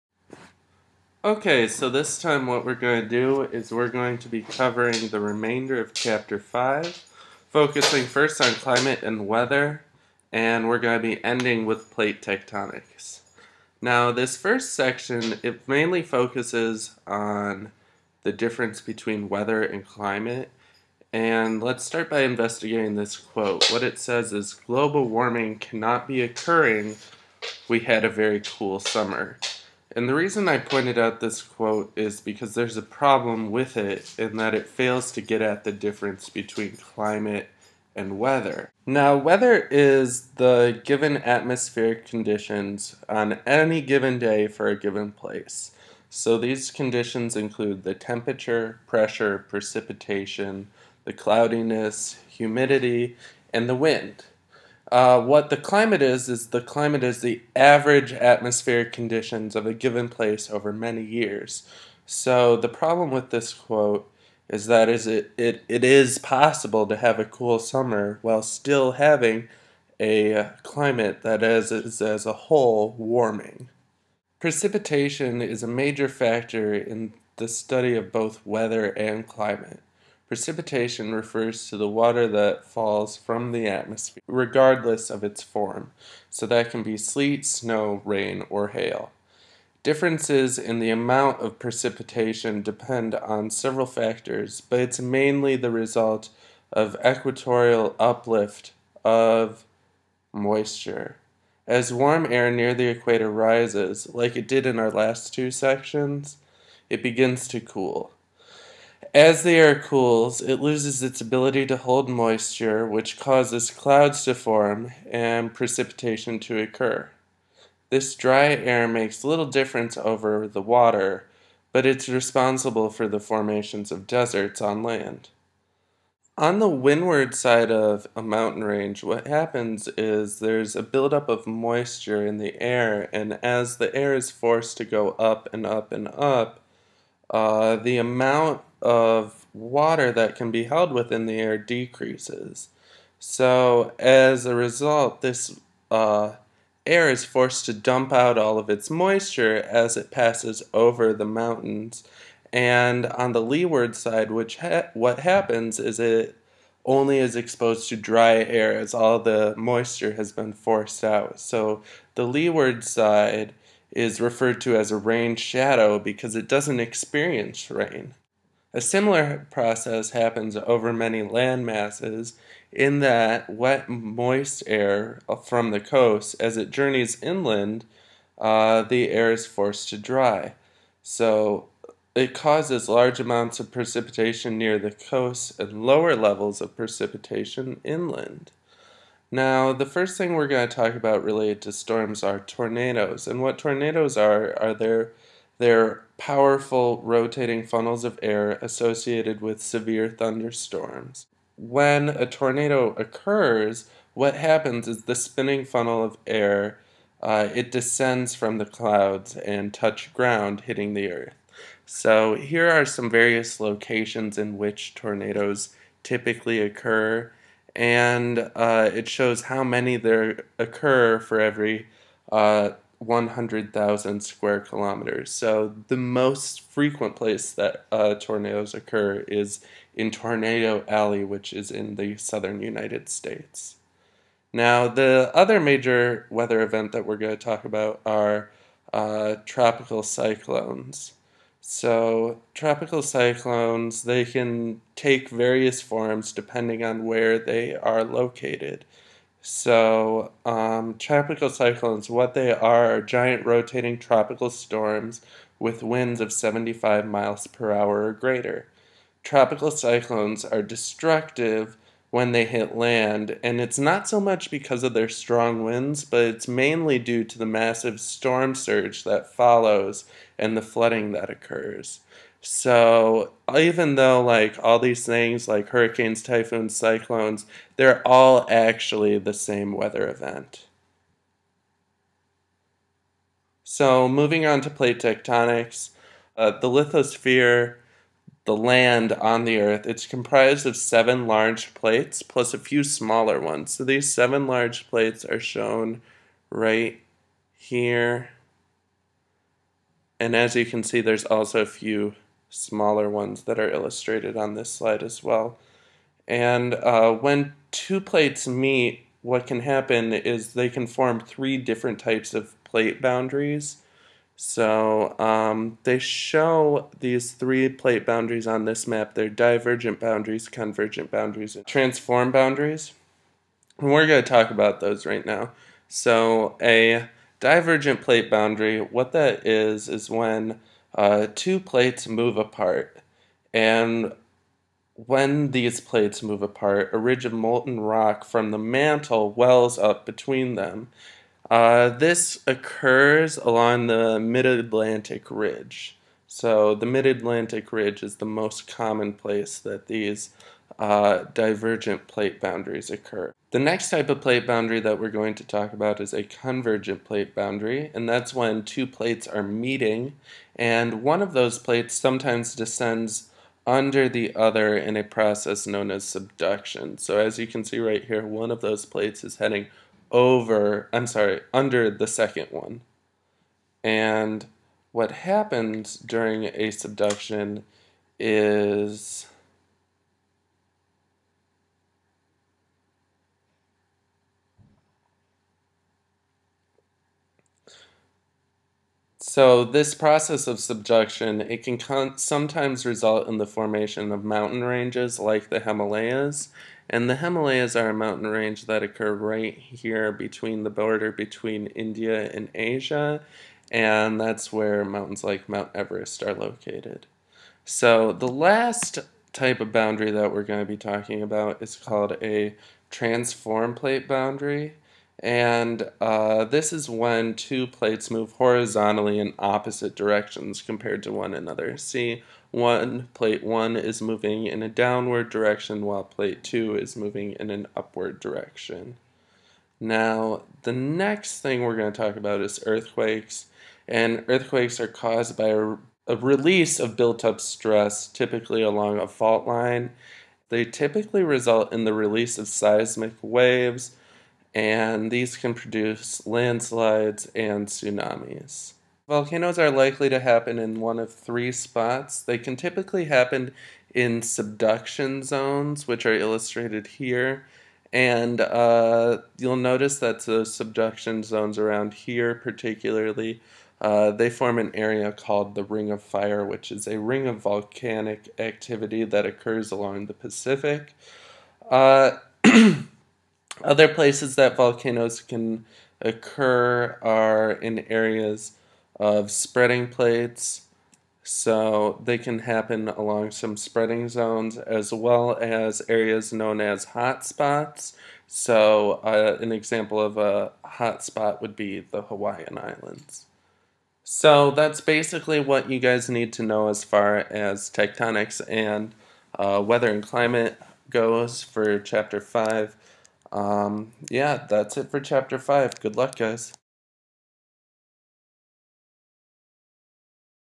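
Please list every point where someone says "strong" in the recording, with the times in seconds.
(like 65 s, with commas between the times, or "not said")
265 s.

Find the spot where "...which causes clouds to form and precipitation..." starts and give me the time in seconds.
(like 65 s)
112 s.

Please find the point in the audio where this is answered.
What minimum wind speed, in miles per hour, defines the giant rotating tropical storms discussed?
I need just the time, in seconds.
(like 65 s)
256 s.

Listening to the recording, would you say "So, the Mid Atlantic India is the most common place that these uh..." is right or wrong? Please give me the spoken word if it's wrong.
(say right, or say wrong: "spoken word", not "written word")
wrong: "Ridge", not "India".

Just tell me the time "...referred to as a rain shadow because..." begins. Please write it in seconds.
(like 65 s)
164 s.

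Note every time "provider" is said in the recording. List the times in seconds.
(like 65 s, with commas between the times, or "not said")
not said.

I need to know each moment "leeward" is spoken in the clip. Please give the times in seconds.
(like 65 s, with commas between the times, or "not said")
153 s, 162 s.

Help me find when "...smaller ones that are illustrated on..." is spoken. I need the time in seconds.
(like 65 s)
302 s.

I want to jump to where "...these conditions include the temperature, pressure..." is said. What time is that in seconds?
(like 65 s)
46 s.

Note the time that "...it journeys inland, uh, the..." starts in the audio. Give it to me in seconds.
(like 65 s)
176 s.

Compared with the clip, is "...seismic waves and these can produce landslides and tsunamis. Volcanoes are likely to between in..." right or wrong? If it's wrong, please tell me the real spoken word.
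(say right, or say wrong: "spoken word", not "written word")
wrong: "happen", not "between".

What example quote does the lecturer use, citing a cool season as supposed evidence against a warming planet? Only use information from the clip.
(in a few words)
a very cool summer.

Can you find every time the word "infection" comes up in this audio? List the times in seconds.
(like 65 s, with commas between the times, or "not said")
not said.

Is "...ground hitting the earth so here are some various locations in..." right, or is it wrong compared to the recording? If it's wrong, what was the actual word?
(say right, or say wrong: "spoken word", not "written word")
right.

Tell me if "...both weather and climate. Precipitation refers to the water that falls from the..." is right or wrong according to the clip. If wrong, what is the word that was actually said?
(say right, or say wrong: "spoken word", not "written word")
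right.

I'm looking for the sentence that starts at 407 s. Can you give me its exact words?
So the last type of boundary that we're going to be talking about is called a transform plate boundary.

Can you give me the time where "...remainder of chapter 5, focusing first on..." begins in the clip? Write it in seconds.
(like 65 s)
5 s.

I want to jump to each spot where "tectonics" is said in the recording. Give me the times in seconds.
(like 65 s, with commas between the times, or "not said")
12 s, 284 s, 497 s.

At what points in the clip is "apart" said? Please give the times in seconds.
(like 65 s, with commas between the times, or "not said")
332 s, 336 s.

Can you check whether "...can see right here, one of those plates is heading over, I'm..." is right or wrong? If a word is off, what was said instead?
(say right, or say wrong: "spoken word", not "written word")
right.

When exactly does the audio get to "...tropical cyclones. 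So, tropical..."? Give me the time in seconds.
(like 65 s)
239 s.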